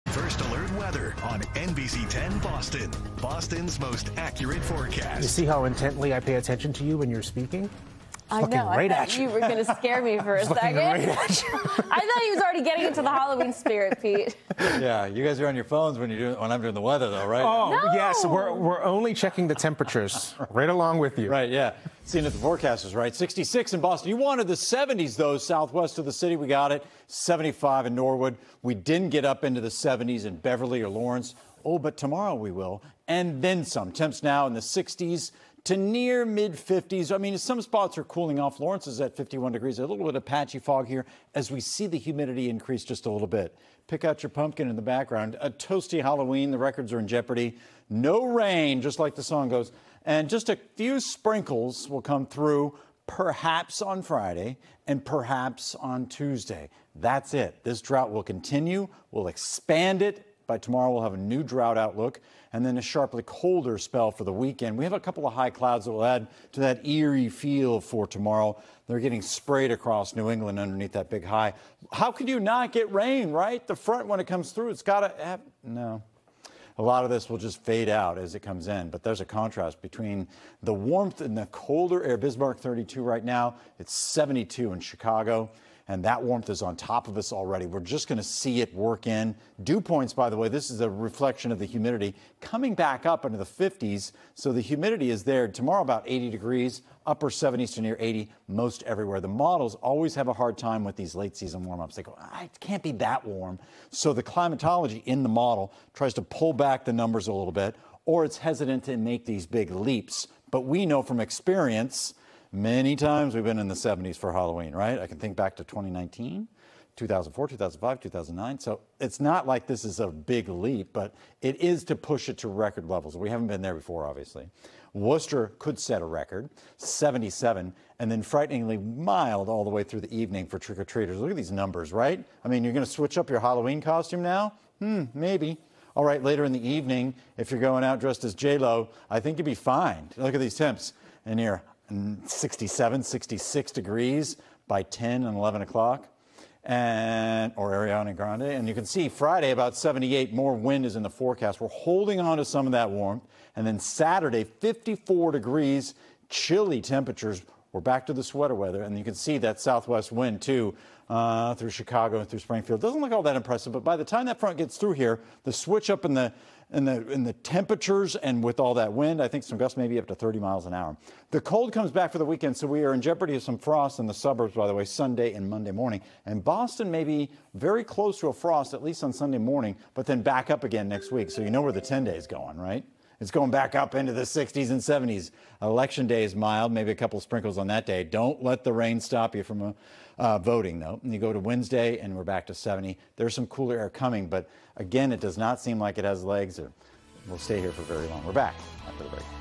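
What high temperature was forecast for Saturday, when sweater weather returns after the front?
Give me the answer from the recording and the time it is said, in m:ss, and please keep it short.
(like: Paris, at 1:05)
54 degrees, at 2:34.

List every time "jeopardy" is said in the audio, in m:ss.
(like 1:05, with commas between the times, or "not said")
0:47, 2:53.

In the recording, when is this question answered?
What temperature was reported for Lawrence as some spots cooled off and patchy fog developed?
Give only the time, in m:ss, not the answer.
0:39.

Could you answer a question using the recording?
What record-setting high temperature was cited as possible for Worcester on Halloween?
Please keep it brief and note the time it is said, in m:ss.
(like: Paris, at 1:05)
77, at 2:06.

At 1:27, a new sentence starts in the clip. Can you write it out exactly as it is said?
We're just going to see it work in.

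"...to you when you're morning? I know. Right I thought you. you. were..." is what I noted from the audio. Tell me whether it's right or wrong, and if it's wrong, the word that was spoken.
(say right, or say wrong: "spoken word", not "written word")
wrong: "speaking", not "morning".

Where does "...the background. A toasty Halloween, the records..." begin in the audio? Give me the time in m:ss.
0:44.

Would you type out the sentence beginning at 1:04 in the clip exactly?
We have a couple of high clouds that will add to that eerie feel for tomorrow.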